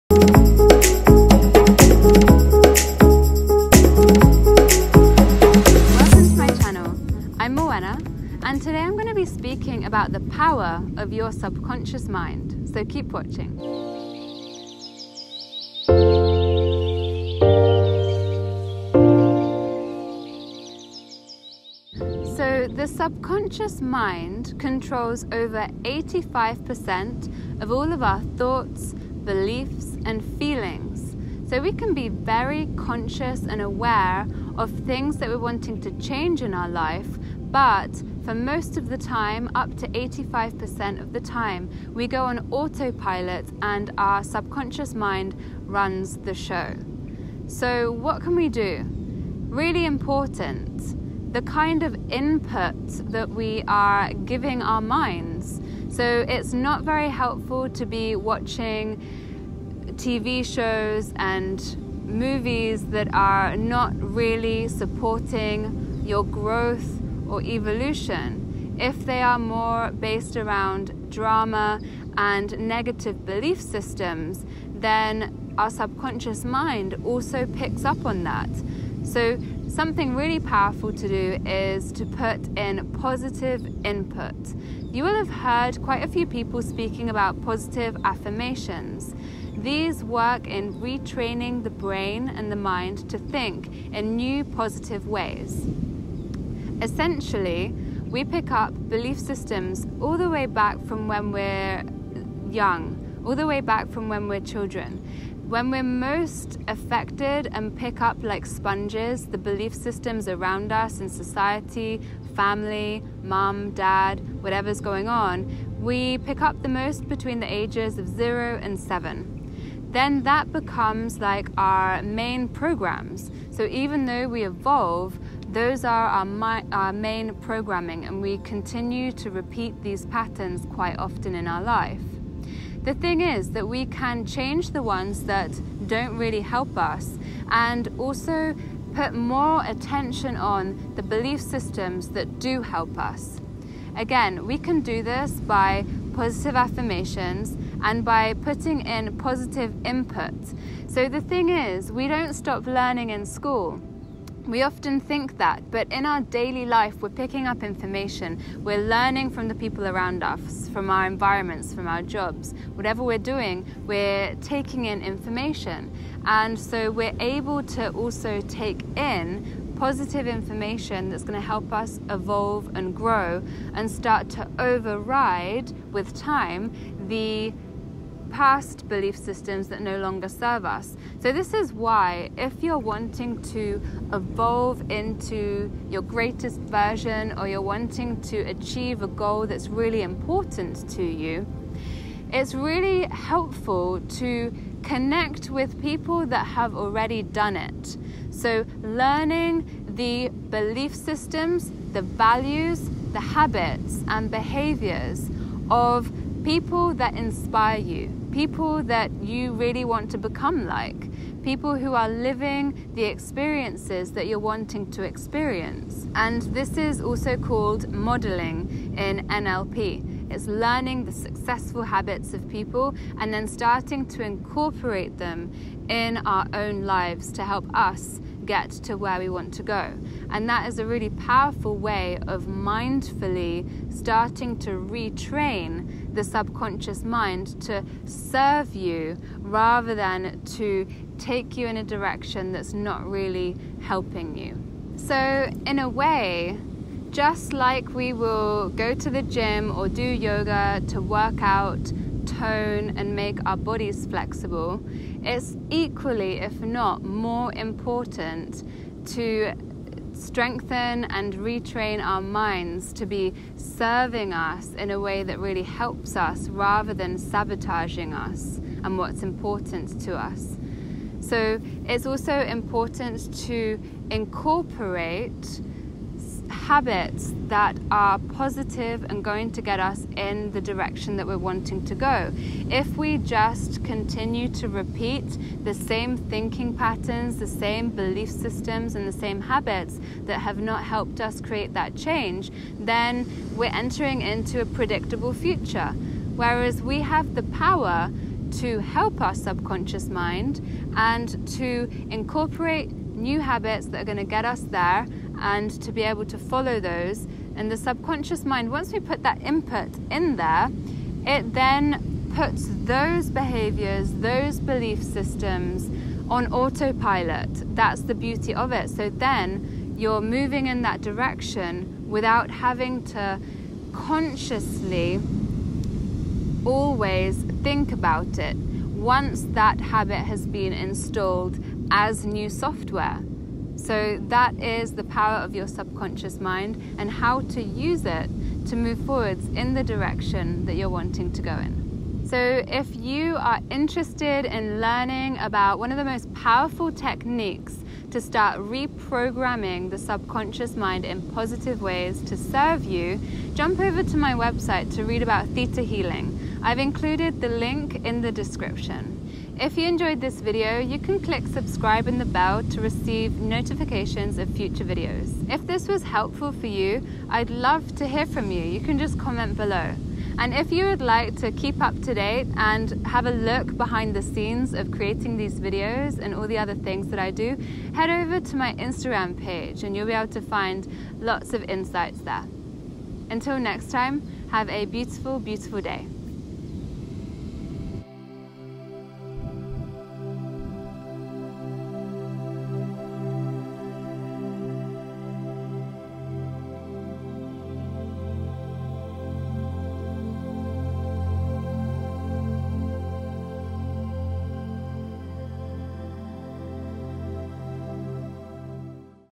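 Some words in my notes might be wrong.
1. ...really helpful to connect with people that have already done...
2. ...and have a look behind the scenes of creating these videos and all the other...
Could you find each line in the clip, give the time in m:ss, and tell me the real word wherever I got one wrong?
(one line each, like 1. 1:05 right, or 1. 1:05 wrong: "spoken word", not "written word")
1. 3:12 right
2. 6:12 right.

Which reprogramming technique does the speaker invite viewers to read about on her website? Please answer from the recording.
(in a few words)
theta healing.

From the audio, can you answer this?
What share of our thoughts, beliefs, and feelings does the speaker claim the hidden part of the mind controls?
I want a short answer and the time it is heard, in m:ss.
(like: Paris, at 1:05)
over 85%, at 0:25.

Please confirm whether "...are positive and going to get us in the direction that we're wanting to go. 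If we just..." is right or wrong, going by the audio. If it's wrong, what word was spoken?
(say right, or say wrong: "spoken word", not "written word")
right.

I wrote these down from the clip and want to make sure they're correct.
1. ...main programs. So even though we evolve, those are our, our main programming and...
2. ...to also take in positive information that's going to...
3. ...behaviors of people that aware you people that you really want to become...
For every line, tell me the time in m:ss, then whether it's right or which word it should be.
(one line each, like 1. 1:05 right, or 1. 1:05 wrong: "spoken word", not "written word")
1. 2:02 right
2. 2:47 right
3. 3:24 wrong: "inspire", not "aware".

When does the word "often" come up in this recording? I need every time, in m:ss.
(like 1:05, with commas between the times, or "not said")
2:10, 2:34.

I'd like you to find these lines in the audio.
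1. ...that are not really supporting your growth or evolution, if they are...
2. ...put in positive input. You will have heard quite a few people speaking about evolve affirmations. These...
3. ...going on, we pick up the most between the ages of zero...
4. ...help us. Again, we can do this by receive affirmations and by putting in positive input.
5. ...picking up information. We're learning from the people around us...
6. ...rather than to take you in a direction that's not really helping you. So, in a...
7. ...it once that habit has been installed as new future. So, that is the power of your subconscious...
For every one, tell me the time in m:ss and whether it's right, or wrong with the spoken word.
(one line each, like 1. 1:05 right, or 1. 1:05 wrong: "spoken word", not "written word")
1. 1:02 right
2. 1:22 wrong: "positive", not "evolve"
3. 1:54 right
4. 2:22 wrong: "positive", not "receive"
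5. 2:37 right
6. 3:59 right
7. 5:28 wrong: "software", not "future".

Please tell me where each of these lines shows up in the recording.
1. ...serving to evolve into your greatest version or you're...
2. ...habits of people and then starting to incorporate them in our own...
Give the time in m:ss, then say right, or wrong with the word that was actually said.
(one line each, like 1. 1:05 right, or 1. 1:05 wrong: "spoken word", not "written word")
1. 3:02 wrong: "wanting", not "serving"
2. 3:41 right.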